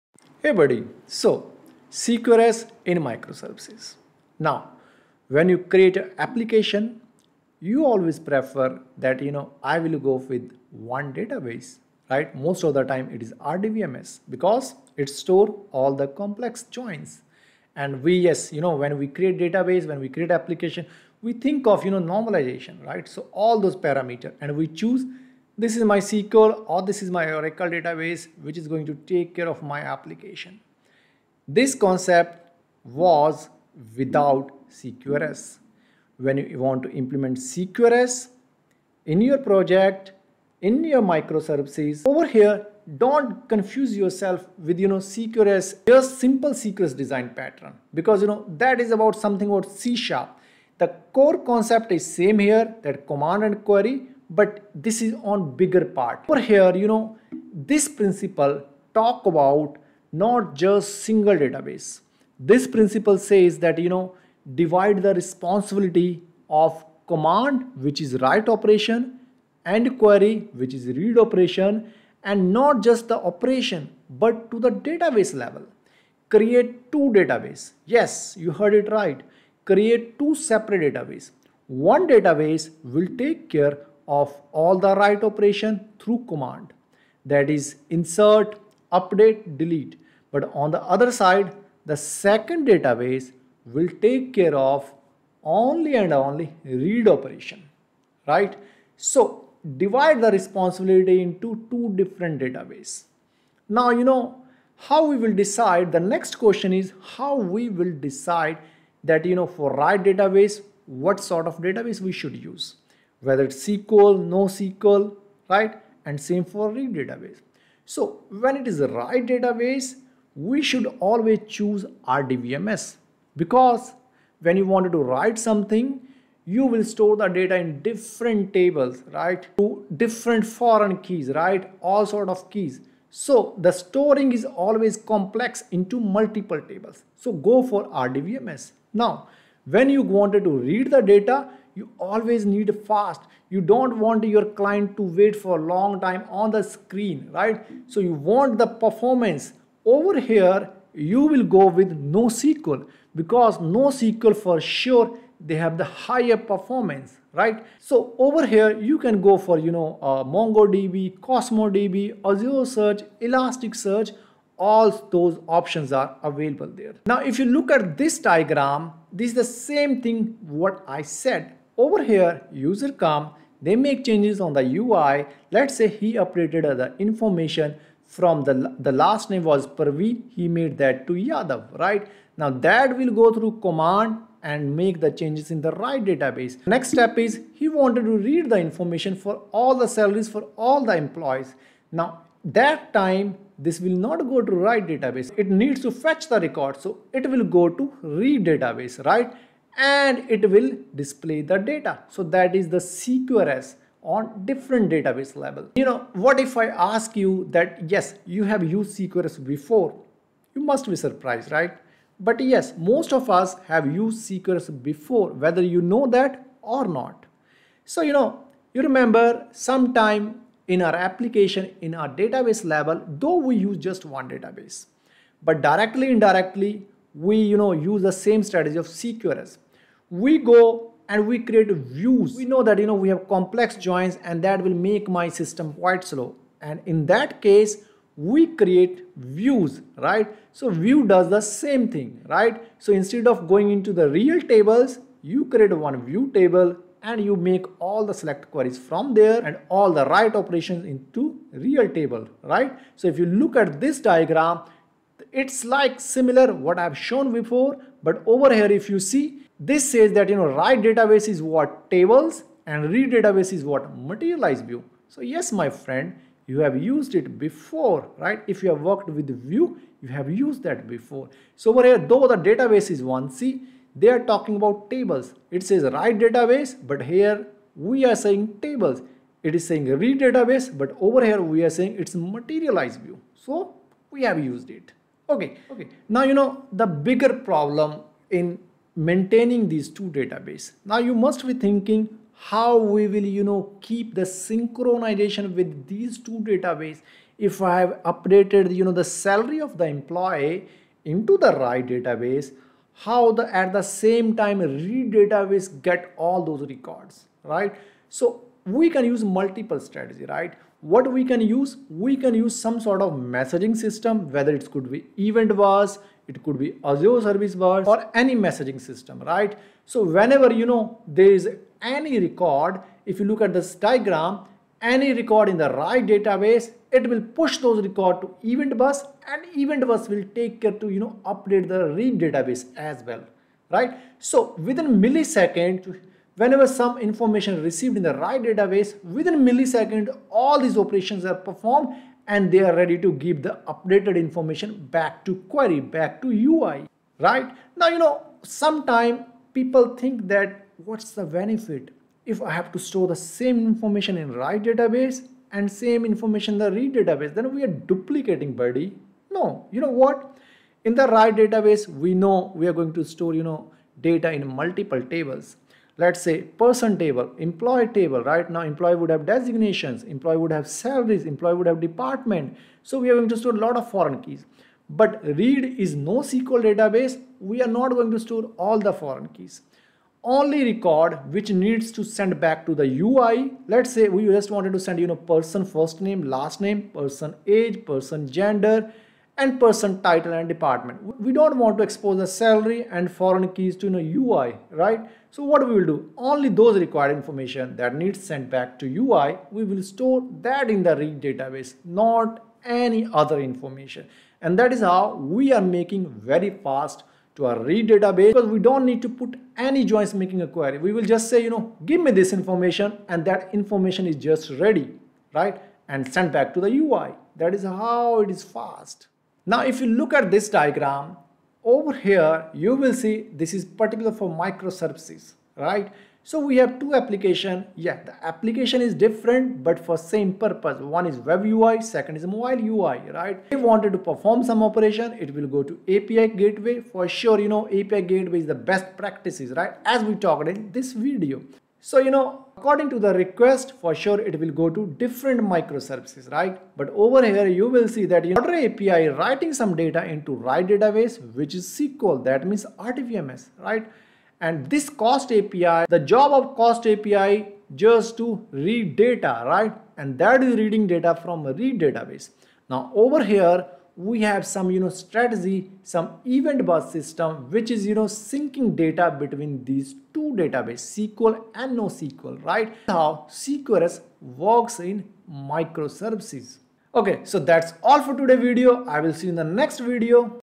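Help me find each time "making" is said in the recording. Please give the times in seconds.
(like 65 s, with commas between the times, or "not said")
405 s, 410 s.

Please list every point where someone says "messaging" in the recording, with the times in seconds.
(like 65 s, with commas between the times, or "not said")
313 s, 318 s.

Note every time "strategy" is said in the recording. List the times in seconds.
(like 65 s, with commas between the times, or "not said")
228 s, 309 s, 464 s.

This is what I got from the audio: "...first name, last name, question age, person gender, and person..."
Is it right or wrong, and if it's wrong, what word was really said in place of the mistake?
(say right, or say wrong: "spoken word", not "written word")
wrong: "person", not "question".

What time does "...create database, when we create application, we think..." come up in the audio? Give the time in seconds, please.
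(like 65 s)
19 s.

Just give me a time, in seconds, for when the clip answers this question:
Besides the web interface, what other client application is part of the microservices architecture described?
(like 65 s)
432 s.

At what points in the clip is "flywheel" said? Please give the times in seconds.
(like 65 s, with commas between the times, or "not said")
not said.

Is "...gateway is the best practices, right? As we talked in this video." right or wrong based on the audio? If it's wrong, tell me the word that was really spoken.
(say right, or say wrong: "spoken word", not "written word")
right.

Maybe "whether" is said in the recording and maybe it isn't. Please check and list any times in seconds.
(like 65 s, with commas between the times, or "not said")
113 s, 215 s, 314 s.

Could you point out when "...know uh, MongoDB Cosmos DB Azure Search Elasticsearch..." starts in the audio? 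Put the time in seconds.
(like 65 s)
159 s.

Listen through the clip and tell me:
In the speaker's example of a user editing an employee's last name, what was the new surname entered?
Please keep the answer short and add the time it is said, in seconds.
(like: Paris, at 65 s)
Yadav, at 181 s.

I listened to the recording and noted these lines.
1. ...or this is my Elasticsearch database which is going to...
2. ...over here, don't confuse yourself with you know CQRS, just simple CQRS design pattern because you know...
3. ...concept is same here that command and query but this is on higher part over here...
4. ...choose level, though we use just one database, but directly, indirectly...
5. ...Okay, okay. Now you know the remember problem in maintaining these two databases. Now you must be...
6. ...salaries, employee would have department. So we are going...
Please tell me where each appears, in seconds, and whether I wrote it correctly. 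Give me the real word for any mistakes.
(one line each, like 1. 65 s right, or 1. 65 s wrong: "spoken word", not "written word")
1. 26 s wrong: "Oracle", not "Elasticsearch"
2. 42 s right
3. 51 s wrong: "bigger", not "higher"
4. 222 s wrong: "database", not "choose"
5. 285 s wrong: "bigger", not "remember"
6. 370 s right.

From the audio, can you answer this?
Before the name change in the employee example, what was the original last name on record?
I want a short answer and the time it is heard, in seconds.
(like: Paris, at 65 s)
Parveen, at 179 s.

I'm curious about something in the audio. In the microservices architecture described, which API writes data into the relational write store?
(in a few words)
order API.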